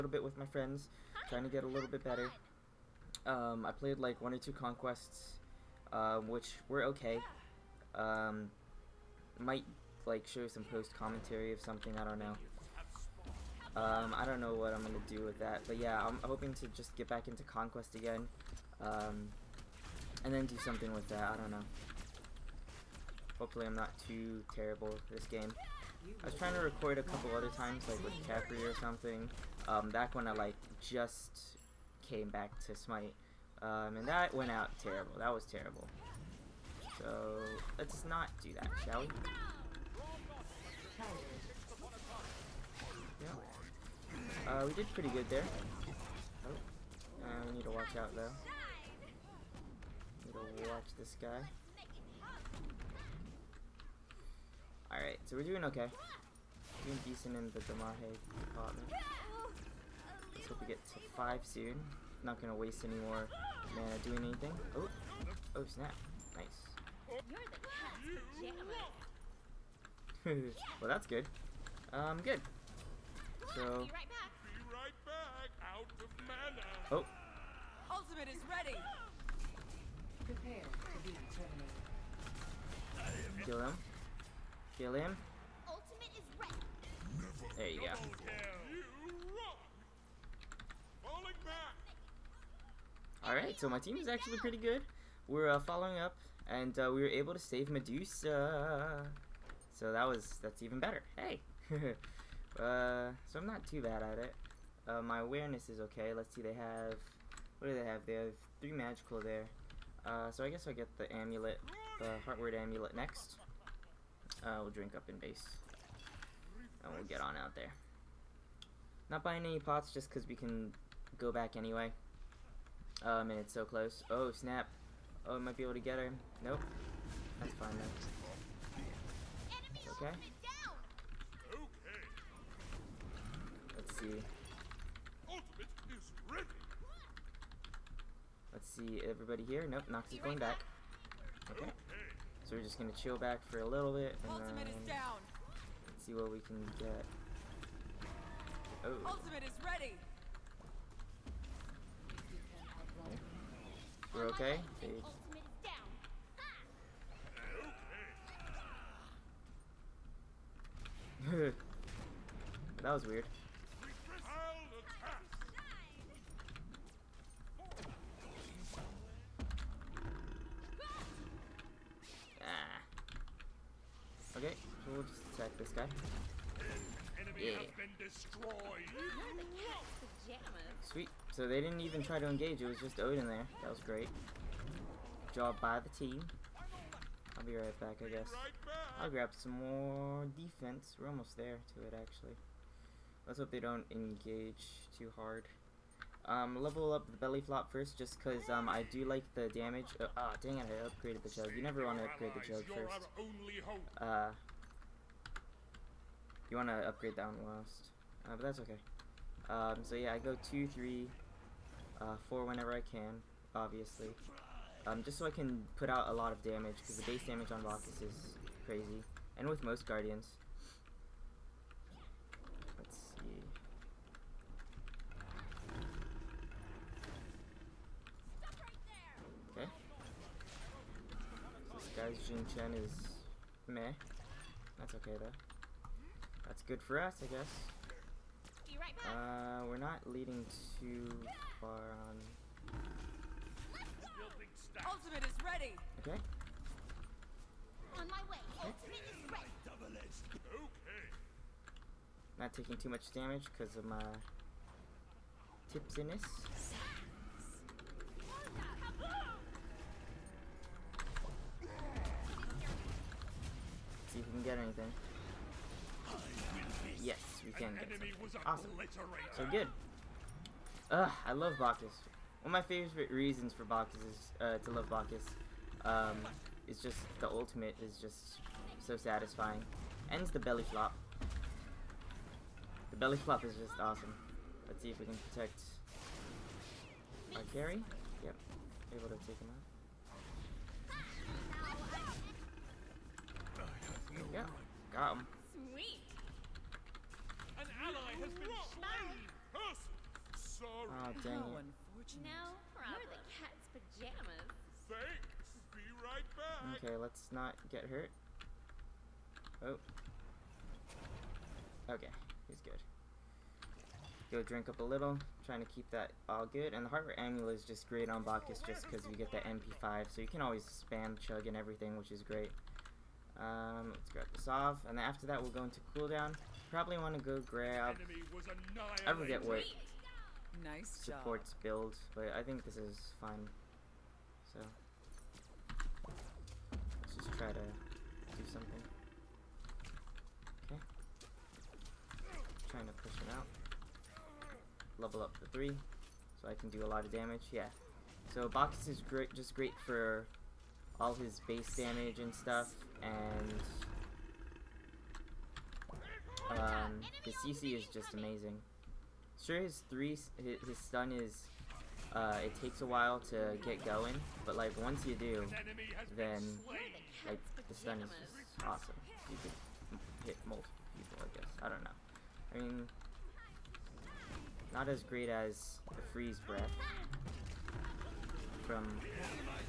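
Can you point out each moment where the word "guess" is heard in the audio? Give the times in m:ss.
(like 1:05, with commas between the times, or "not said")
1:50, 3:08, 3:57, 6:11.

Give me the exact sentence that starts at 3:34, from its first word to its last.
Um, just so I can put out a lot of damage, because the base damage on Bacchus is crazy.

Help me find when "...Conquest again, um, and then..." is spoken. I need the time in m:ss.
0:17.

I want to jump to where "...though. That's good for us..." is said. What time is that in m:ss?
3:55.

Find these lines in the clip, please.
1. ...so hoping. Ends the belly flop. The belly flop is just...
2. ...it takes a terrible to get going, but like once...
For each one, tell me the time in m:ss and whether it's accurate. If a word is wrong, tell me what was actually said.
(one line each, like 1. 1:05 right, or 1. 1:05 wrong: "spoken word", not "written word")
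1. 4:38 wrong: "satisfying", not "hoping"
2. 6:02 wrong: "while", not "terrible".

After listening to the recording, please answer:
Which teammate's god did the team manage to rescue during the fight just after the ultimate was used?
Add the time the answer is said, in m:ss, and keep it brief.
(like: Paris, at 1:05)
Medusa, at 1:37.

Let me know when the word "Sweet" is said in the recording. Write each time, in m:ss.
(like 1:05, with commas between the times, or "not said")
3:00, 4:55.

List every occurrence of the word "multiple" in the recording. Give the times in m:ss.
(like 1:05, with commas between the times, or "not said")
6:10.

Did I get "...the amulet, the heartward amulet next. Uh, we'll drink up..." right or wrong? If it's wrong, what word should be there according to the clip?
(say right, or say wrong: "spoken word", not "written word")
right.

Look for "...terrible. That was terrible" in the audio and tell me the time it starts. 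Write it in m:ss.
0:34.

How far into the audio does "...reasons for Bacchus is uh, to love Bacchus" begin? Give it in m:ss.
4:33.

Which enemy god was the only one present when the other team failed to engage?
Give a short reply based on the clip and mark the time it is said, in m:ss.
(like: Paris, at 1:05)
Odin, at 3:02.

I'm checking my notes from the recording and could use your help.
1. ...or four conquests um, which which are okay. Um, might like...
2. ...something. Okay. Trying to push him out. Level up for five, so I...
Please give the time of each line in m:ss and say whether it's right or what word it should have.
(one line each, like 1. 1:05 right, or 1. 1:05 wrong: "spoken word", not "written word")
1. 0:04 wrong: "two", not "four"
2. 5:38 wrong: "three", not "five".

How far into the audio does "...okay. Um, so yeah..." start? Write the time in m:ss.
3:28.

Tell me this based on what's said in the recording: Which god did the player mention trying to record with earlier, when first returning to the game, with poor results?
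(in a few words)
Capri.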